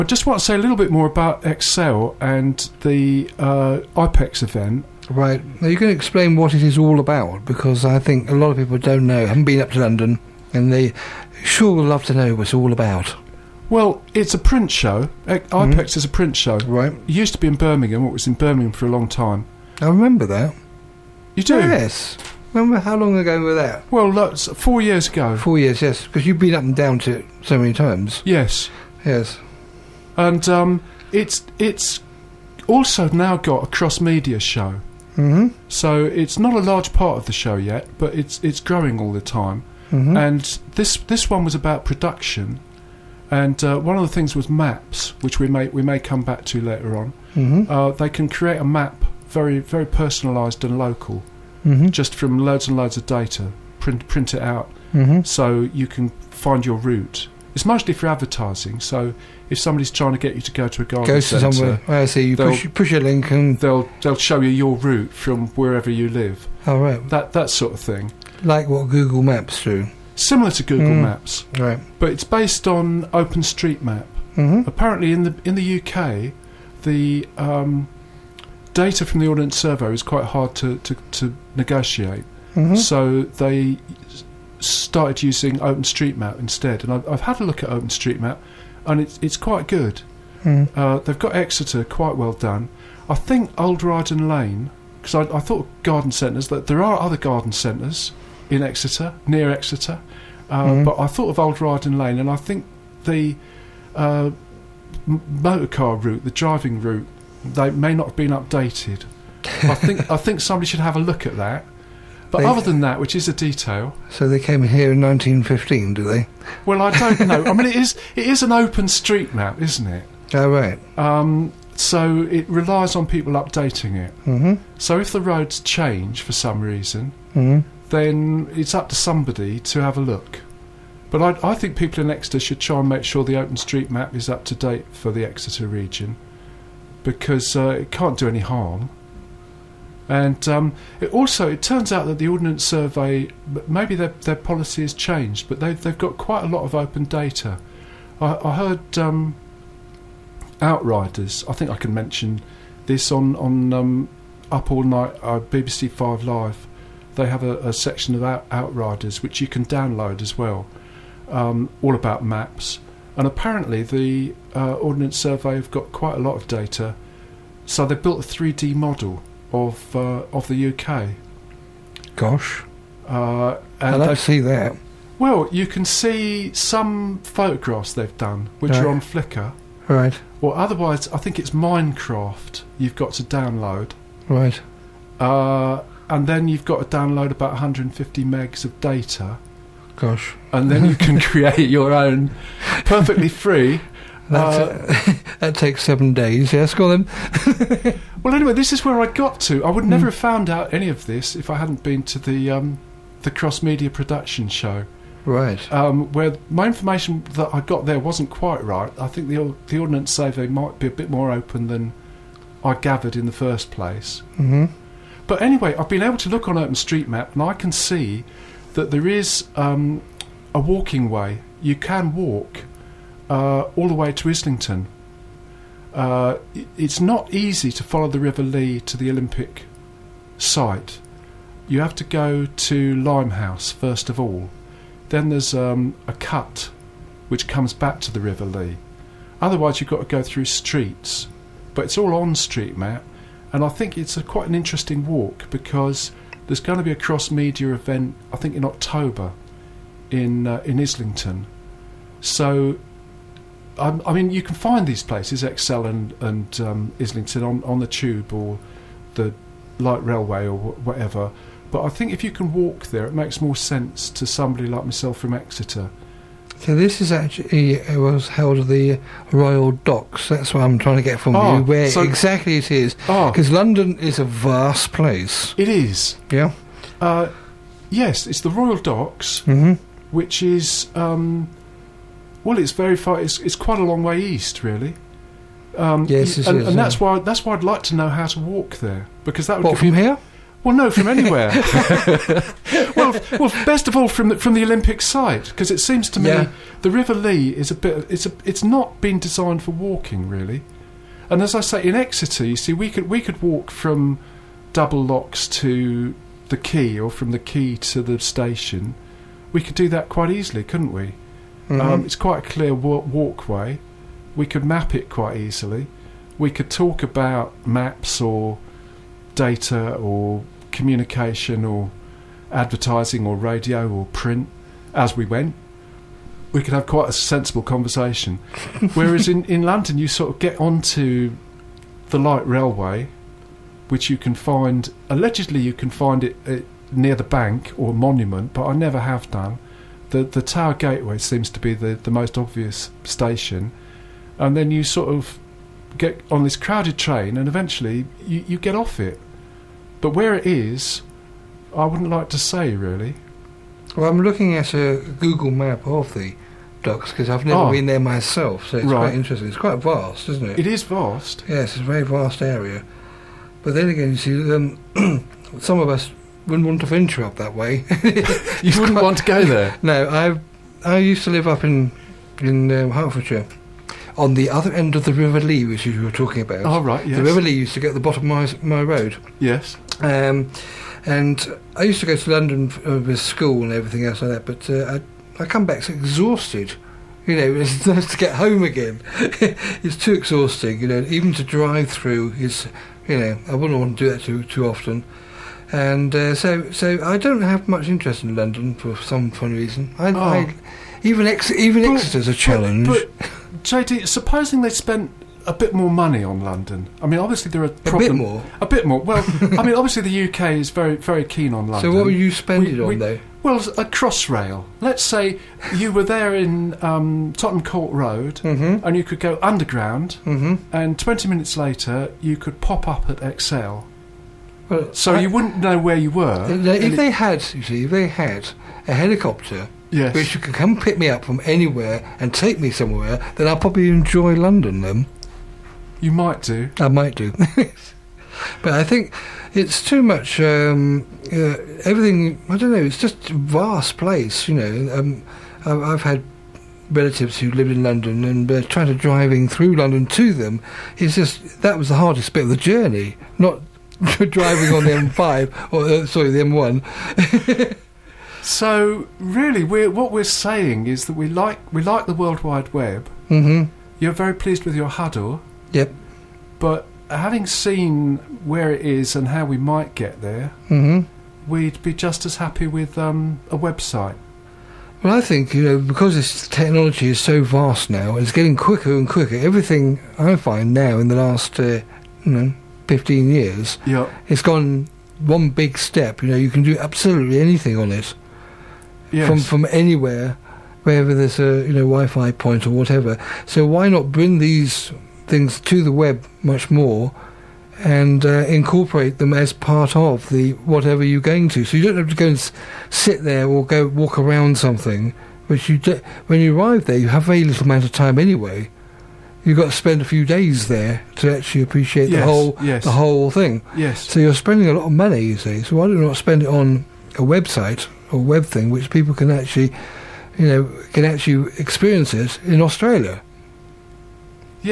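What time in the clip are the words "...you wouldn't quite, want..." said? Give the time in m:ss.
6:08.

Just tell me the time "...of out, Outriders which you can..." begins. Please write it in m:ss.
2:38.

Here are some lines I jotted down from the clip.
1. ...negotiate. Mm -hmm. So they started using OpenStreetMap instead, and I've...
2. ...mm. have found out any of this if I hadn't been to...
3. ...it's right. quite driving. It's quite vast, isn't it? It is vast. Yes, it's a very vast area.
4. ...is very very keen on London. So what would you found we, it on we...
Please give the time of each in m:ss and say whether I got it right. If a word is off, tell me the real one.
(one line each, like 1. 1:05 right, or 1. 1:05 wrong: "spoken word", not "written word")
1. 1:21 right
2. 3:20 right
3. 5:58 wrong: "interesting", not "driving"
4. 6:50 wrong: "spend", not "found".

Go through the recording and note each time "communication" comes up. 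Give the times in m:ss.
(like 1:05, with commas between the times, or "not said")
5:20.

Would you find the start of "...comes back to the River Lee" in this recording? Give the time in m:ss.
3:57.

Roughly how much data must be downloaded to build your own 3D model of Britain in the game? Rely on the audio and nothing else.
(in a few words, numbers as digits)
150 megs.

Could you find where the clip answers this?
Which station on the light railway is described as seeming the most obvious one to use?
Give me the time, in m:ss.
5:40.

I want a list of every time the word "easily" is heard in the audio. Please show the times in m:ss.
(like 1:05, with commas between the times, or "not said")
5:10, 5:15.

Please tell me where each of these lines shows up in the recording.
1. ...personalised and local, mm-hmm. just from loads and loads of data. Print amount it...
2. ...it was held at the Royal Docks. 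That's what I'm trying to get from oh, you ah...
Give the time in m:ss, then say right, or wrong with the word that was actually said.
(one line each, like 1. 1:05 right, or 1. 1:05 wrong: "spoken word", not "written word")
1. 0:49 wrong: "print", not "amount"
2. 4:27 right.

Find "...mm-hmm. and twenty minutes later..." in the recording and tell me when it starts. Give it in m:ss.
7:00.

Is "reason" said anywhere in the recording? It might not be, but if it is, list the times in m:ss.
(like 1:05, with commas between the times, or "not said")
2:06, 6:39.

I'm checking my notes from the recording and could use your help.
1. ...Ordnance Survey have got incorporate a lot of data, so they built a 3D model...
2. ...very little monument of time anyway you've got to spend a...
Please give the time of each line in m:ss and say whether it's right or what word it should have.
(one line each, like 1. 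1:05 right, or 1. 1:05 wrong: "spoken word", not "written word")
1. 2:44 wrong: "quite", not "incorporate"
2. 8:27 wrong: "amount", not "monument".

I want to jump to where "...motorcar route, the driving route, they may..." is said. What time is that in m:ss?
1:45.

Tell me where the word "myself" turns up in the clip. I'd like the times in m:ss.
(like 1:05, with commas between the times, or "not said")
4:24, 5:57.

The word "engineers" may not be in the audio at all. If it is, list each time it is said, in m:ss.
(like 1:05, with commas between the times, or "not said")
not said.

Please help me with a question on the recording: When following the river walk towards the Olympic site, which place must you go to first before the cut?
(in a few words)
Limehouse.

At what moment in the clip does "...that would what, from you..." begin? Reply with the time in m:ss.
4:49.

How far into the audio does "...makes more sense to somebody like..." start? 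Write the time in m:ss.
4:23.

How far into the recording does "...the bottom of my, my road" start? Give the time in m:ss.
6:17.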